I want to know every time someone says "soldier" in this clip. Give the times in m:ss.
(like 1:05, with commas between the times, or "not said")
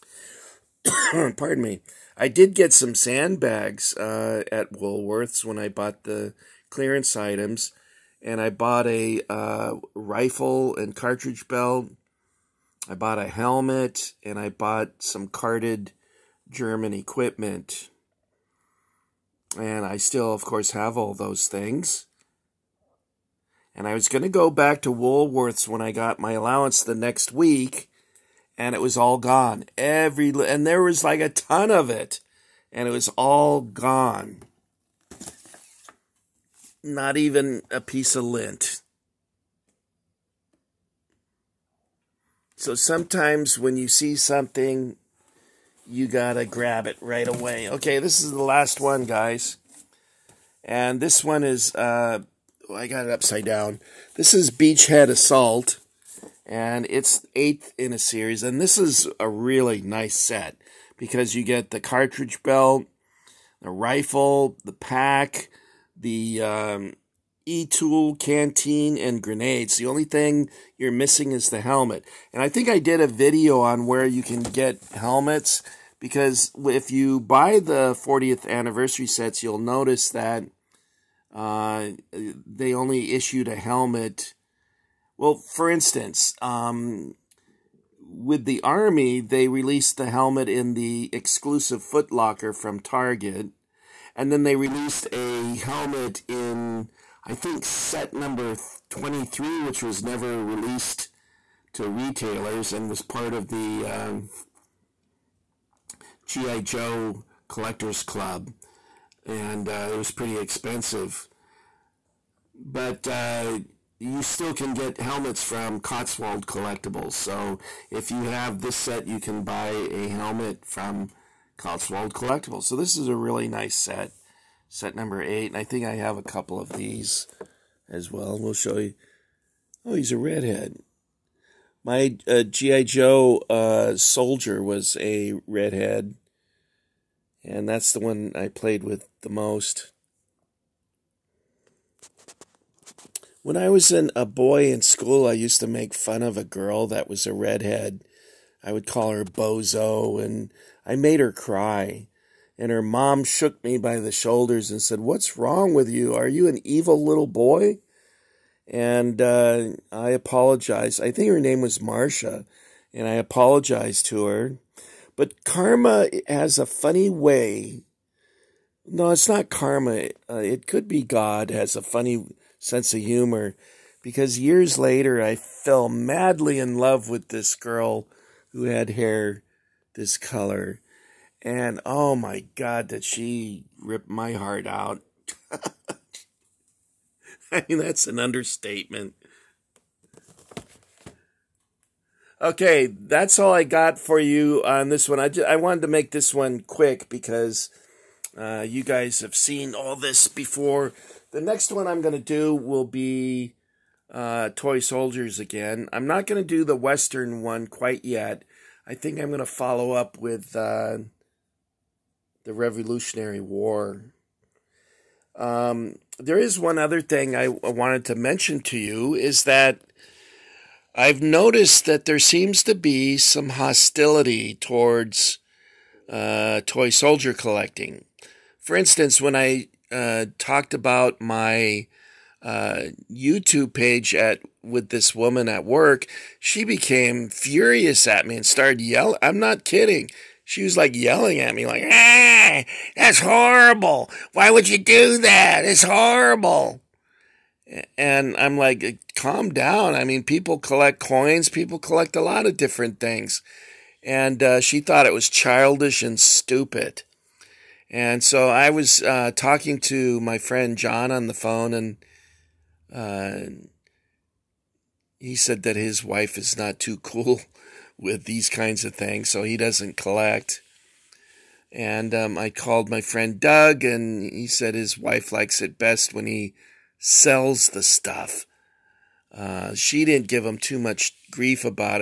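2:13, 3:24, 3:46.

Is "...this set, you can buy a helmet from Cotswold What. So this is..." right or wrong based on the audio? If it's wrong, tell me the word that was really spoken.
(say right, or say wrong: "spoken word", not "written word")
wrong: "Collectibles", not "What".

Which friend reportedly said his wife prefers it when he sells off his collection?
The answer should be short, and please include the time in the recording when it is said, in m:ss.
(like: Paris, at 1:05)
Doug, at 4:33.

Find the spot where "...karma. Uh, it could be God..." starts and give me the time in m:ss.
2:49.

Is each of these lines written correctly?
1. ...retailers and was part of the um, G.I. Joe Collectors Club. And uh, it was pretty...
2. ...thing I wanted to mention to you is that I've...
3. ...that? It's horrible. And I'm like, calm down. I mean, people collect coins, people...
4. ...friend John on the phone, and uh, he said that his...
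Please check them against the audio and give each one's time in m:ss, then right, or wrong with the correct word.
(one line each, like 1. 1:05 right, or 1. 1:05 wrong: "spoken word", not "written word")
1. 1:41 right
2. 3:37 right
3. 4:05 right
4. 4:20 right.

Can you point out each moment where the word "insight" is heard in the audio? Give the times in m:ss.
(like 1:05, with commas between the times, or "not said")
not said.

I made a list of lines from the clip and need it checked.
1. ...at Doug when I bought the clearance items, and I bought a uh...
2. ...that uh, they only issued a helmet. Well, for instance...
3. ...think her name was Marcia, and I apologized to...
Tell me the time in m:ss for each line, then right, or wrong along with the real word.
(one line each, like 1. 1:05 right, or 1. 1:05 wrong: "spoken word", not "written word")
1. 0:04 wrong: "Woolworths", not "Doug"
2. 1:20 right
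3. 2:41 right.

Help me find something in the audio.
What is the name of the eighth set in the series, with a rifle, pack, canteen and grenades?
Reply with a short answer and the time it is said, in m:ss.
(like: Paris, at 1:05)
Beachhead Assault, at 0:54.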